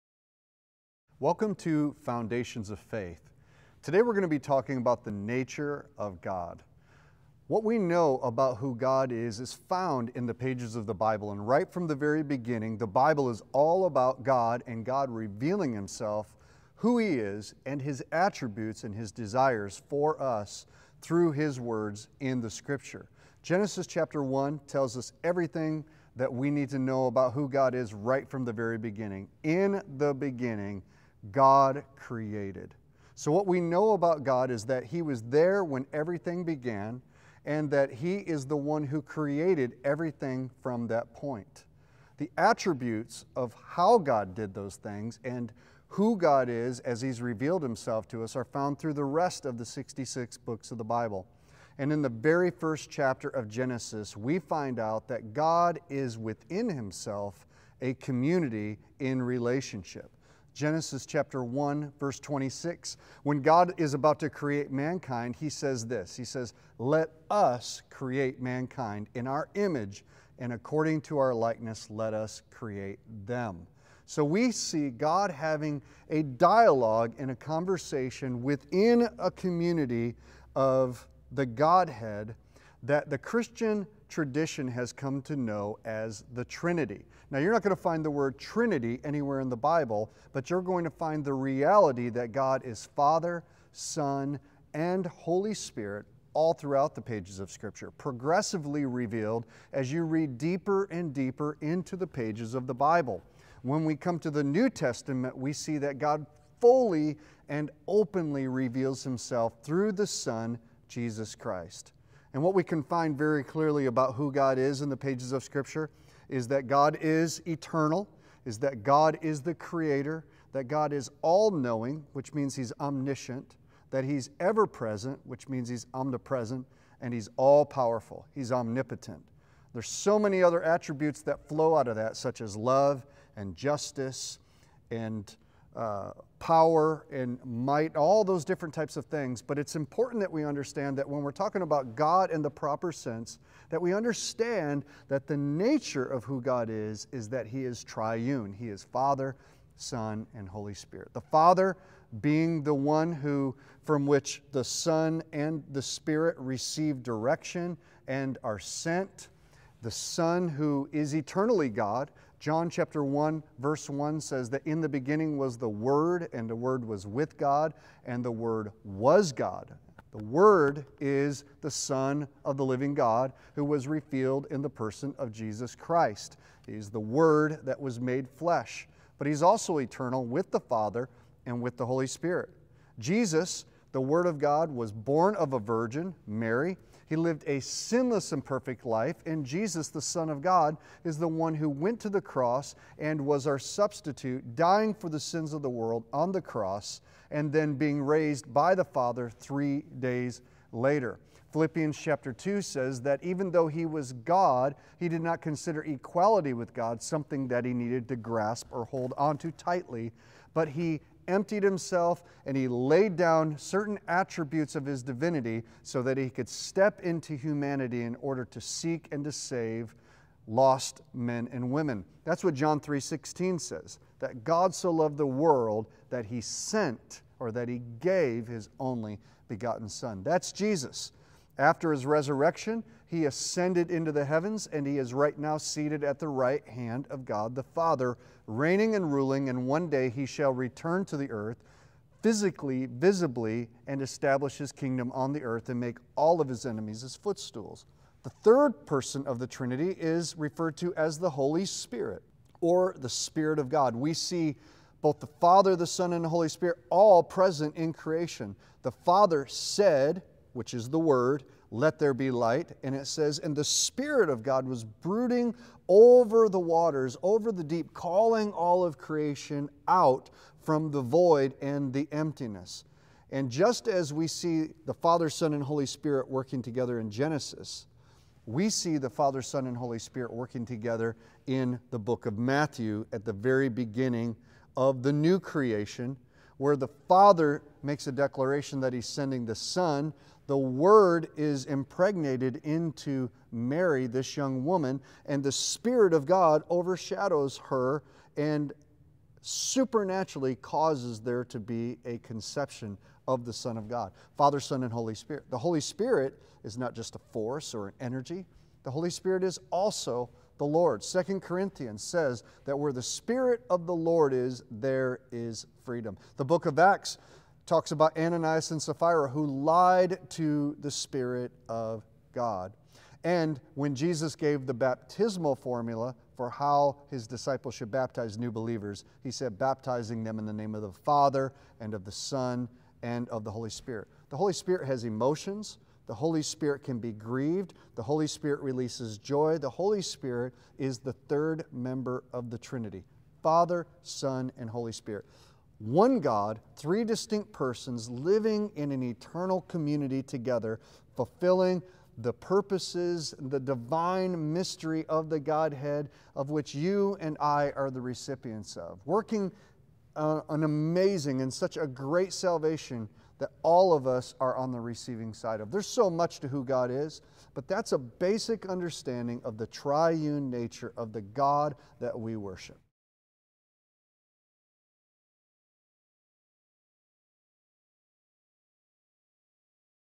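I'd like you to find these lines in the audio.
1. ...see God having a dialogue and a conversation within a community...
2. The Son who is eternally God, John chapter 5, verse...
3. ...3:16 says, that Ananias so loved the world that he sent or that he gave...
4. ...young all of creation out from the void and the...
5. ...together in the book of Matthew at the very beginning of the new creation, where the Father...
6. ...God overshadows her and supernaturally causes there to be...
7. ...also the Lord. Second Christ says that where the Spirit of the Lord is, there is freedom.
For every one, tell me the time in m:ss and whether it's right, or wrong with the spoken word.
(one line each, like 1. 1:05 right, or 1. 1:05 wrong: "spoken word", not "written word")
1. 1:14 right
2. 2:39 wrong: "1", not "5"
3. 3:42 wrong: "God", not "Ananias"
4. 4:27 wrong: "calling", not "young"
5. 4:40 right
6. 4:56 right
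7. 5:09 wrong: "Corinthians", not "Christ".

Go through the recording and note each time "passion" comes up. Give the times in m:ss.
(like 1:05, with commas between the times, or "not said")
not said.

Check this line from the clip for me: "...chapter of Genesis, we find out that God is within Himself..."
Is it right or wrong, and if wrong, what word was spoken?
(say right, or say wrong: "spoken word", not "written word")
right.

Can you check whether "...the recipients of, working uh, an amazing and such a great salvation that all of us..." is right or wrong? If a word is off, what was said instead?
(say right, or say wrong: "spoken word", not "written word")
right.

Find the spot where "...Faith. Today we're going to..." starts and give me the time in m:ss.
0:02.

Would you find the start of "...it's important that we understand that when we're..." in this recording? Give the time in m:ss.
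2:19.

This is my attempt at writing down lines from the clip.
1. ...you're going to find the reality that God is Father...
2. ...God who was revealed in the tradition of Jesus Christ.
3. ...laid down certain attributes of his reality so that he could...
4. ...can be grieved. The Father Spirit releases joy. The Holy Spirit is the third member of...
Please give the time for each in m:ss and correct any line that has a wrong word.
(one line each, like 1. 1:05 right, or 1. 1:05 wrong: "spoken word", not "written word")
1. 1:30 right
2. 2:52 wrong: "person", not "tradition"
3. 3:32 wrong: "divinity", not "reality"
4. 5:36 wrong: "Holy", not "Father".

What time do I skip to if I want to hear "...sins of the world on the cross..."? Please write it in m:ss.
3:15.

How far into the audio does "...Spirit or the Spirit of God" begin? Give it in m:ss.
4:11.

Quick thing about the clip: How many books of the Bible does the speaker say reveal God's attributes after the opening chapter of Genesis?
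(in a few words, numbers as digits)
66.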